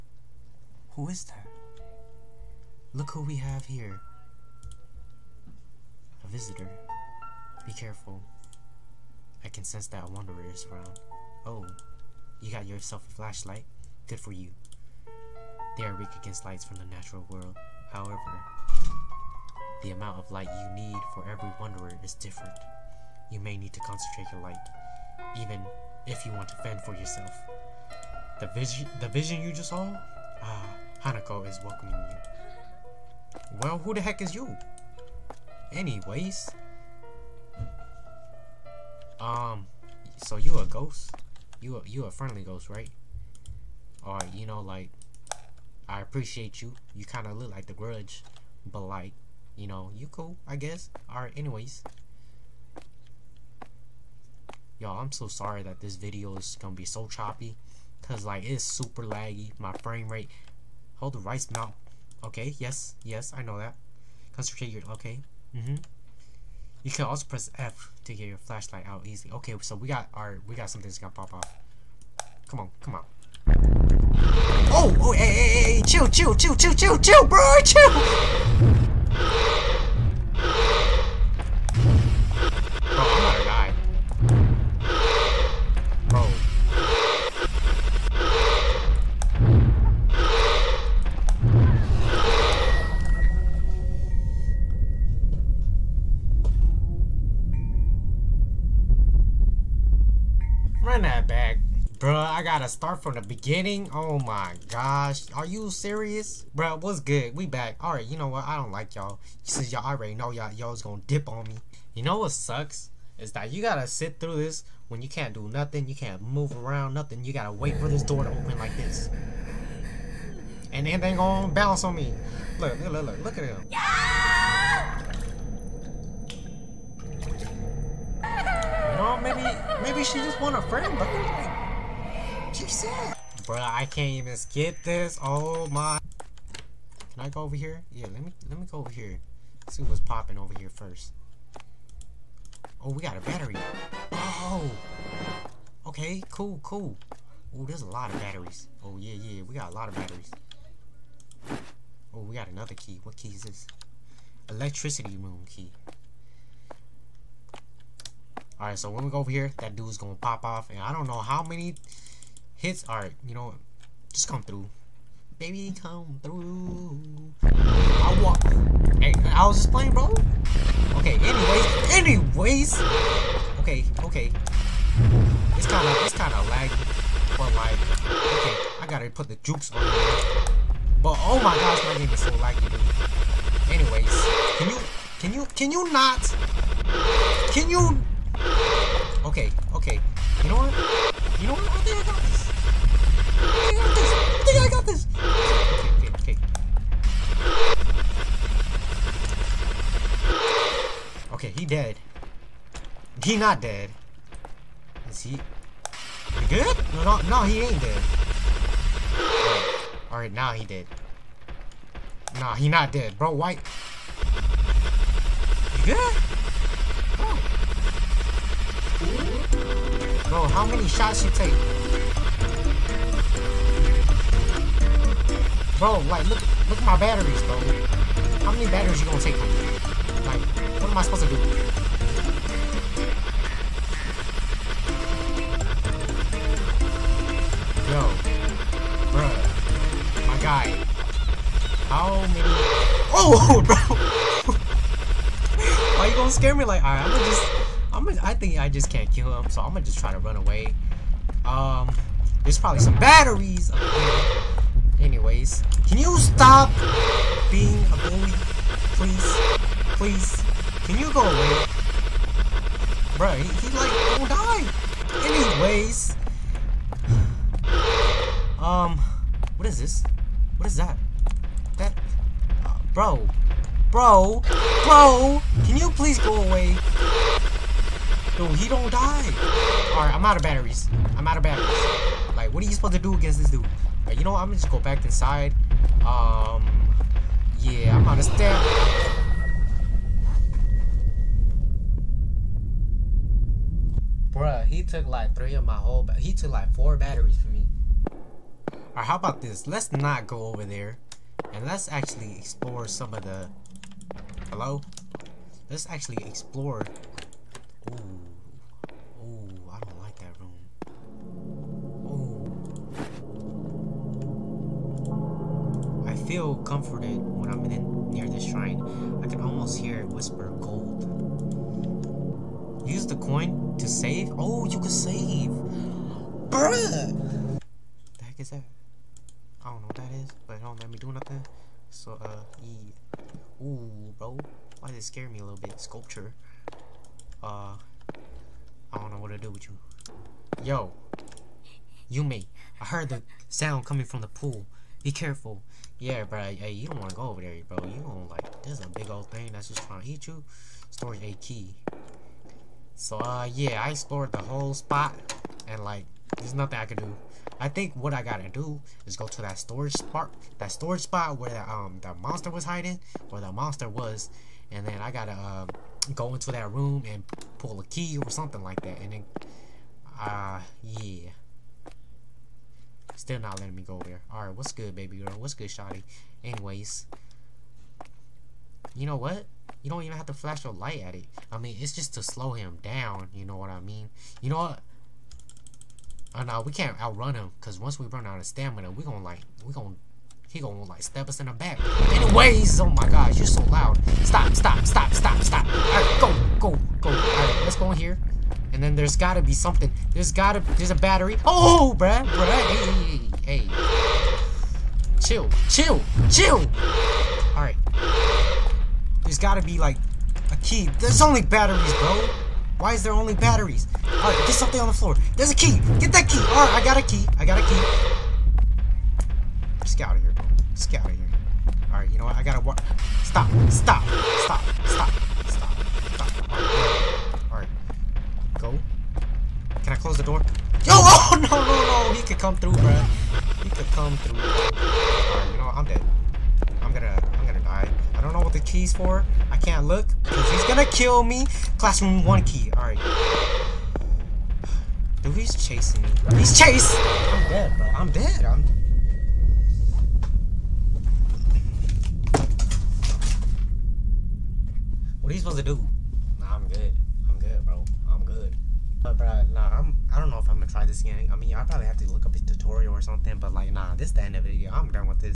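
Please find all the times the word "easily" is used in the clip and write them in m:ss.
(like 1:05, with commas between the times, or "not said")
1:09.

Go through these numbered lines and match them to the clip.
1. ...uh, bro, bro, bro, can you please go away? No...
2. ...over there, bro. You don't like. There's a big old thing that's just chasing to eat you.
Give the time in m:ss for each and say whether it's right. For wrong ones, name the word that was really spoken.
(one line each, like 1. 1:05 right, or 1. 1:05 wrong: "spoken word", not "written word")
1. 4:32 right
2. 5:47 wrong: "trying", not "chasing".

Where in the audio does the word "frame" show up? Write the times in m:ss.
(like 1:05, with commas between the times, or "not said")
0:59.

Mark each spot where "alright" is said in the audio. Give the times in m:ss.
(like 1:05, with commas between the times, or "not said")
0:51, 1:47, 2:38, 3:30, 4:06, 4:39, 4:58, 6:14.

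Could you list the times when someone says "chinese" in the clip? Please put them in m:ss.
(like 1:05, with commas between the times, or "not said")
not said.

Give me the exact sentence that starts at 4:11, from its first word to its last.
Um, there's probably some batteries anyways.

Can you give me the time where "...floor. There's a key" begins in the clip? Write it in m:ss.
6:54.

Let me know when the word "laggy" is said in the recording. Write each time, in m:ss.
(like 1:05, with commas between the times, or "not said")
0:59, 2:56, 3:02.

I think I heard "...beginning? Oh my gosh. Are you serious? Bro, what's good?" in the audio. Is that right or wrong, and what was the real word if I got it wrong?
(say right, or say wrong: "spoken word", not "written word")
right.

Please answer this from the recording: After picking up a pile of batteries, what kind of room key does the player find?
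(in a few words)
Electricity room key.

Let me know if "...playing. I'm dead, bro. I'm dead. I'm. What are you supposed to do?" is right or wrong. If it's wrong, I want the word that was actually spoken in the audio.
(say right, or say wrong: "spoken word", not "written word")
wrong: "chasing", not "playing".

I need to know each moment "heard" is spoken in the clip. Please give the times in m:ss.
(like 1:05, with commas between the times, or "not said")
5:42.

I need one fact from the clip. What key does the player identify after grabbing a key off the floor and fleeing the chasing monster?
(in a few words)
Classroom one key.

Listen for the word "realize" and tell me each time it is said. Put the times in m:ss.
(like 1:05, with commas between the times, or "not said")
not said.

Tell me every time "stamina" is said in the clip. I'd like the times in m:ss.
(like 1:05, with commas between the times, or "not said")
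6:28.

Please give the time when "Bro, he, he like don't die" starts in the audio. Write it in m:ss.
4:23.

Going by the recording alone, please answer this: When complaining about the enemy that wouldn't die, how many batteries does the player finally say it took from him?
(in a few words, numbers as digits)
4.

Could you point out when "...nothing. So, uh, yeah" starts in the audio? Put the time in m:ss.
5:31.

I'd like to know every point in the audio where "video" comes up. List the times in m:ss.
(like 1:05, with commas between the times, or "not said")
0:55, 7:44.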